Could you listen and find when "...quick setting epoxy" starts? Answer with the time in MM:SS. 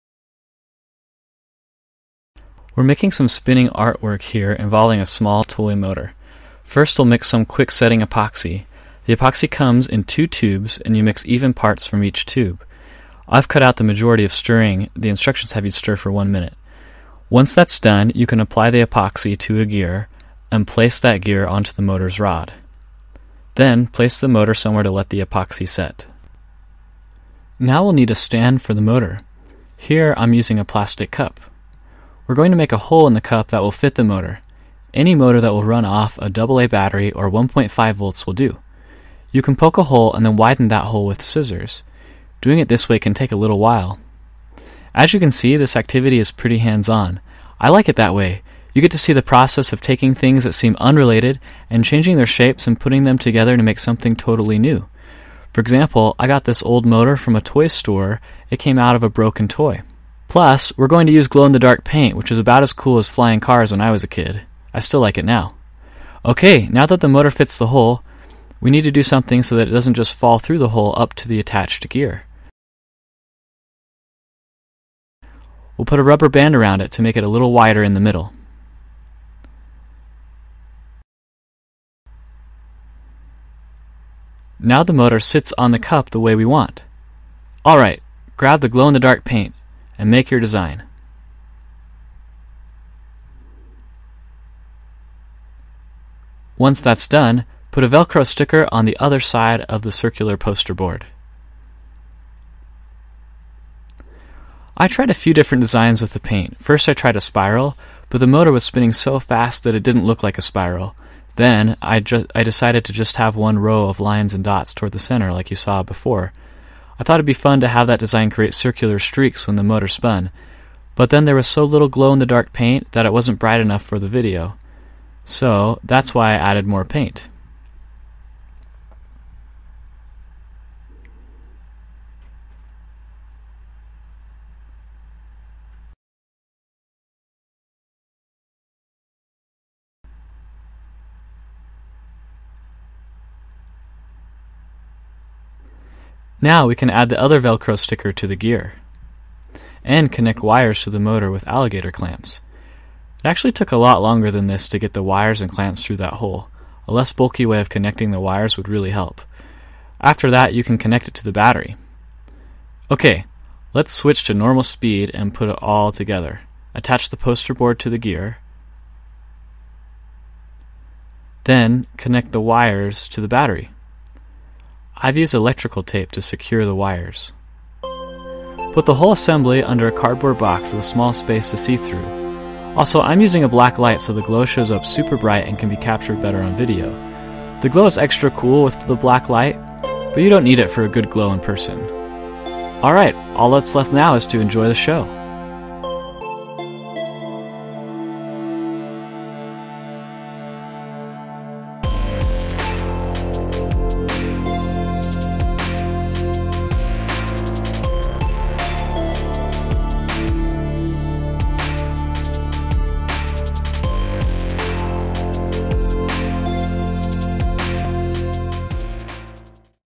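00:07.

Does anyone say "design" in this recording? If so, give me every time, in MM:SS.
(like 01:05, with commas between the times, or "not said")
01:30, 01:45, 01:57.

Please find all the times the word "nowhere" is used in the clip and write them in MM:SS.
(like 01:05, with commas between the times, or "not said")
not said.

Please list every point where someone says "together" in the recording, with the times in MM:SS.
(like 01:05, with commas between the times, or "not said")
00:53, 02:45.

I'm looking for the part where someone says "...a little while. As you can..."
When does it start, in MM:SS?
00:43.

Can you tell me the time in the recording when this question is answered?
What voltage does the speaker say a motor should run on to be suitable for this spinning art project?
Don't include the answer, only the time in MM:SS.
00:37.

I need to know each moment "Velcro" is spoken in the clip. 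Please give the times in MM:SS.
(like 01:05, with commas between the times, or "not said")
01:37, 02:27.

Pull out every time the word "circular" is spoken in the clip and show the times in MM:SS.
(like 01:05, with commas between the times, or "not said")
01:39, 01:58.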